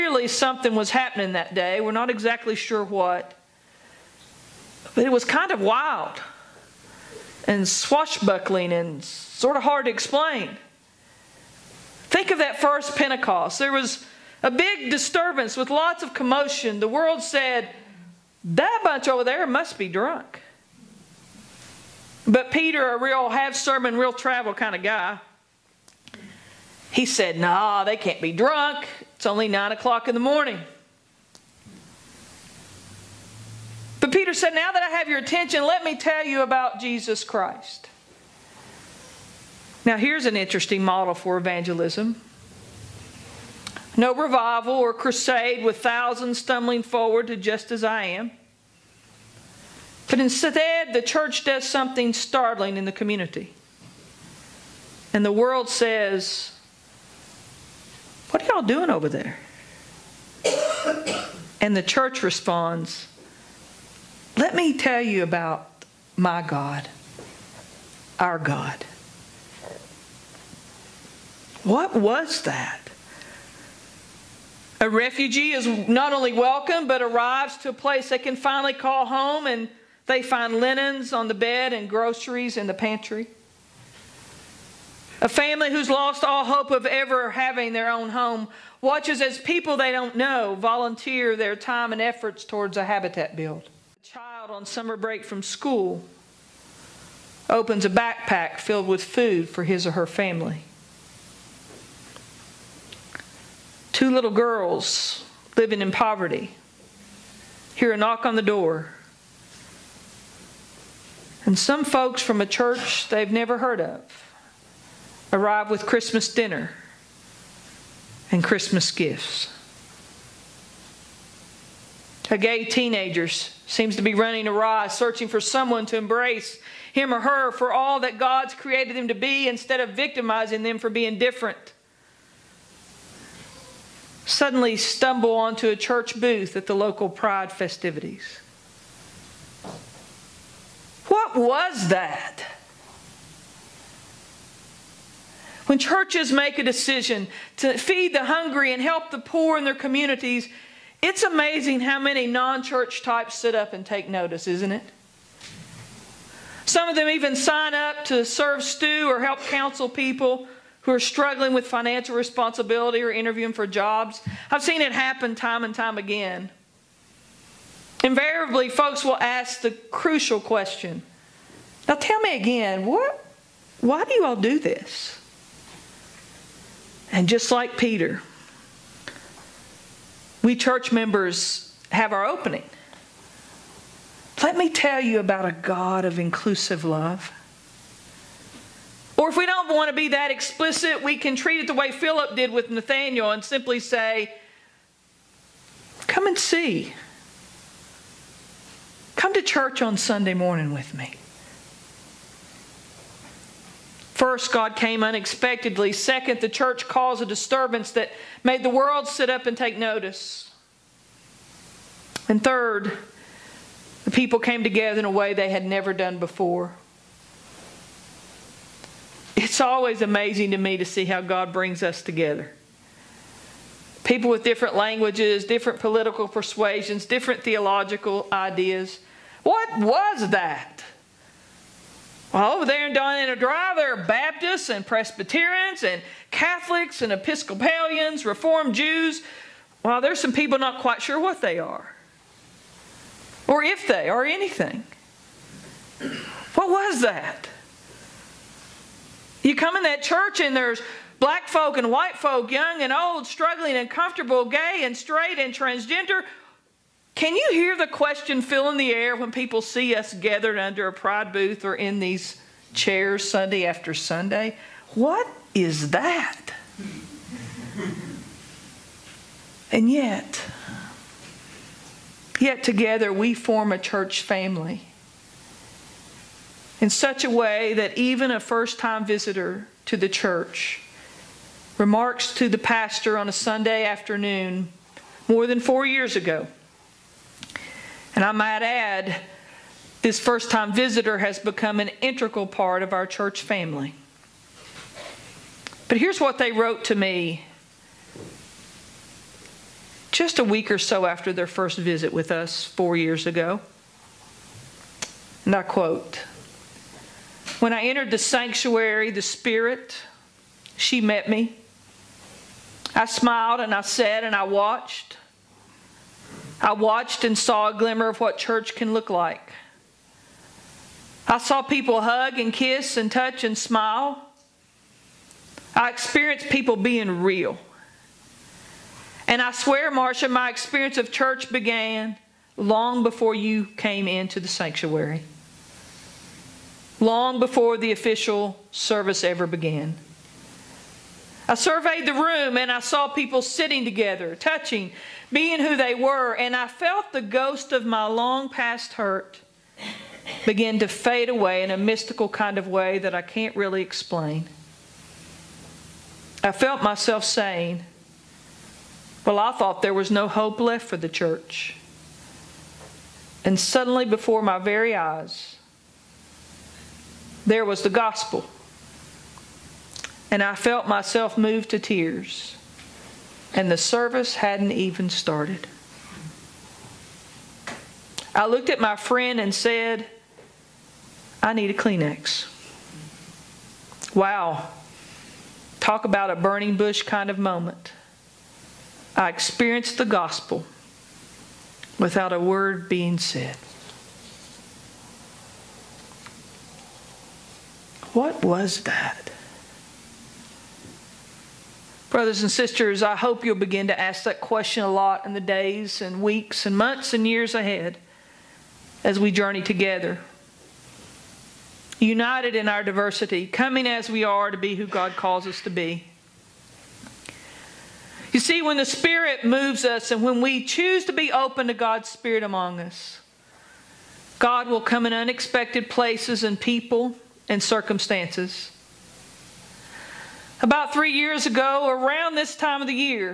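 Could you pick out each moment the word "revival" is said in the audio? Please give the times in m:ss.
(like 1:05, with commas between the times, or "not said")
0:44.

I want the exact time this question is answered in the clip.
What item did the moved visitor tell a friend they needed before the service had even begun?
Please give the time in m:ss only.
6:21.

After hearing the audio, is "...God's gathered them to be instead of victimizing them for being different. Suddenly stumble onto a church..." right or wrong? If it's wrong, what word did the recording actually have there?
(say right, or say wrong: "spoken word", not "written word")
wrong: "created", not "gathered".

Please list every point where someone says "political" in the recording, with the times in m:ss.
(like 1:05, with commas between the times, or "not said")
3:45.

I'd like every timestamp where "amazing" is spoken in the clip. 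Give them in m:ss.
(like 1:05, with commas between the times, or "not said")
2:31, 3:39.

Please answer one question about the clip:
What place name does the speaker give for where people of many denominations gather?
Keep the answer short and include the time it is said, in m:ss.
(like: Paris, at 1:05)
Donina Drive, at 3:52.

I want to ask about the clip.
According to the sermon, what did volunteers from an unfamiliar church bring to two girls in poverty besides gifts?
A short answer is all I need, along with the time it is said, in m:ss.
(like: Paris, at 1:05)
Christmas dinner, at 1:55.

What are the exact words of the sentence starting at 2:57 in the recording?
And just like Peter, we church members have our opening.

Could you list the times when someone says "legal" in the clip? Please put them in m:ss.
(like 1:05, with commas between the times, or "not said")
not said.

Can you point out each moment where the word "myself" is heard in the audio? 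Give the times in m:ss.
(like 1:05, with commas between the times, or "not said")
5:56, 6:10.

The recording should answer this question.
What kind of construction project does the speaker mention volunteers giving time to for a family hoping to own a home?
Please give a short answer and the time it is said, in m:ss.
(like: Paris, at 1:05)
Habitat build, at 1:32.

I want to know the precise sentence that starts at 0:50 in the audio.
But instead, the church does something startling in the community.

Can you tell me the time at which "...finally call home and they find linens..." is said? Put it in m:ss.
1:18.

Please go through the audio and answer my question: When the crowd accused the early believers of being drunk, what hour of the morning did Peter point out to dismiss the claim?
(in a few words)
9 o'clock.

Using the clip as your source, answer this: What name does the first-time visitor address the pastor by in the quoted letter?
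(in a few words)
Marsha.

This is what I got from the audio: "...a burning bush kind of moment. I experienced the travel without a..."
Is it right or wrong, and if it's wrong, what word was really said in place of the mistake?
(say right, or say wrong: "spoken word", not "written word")
wrong: "gospel", not "travel".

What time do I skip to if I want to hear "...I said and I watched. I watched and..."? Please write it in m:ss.
5:13.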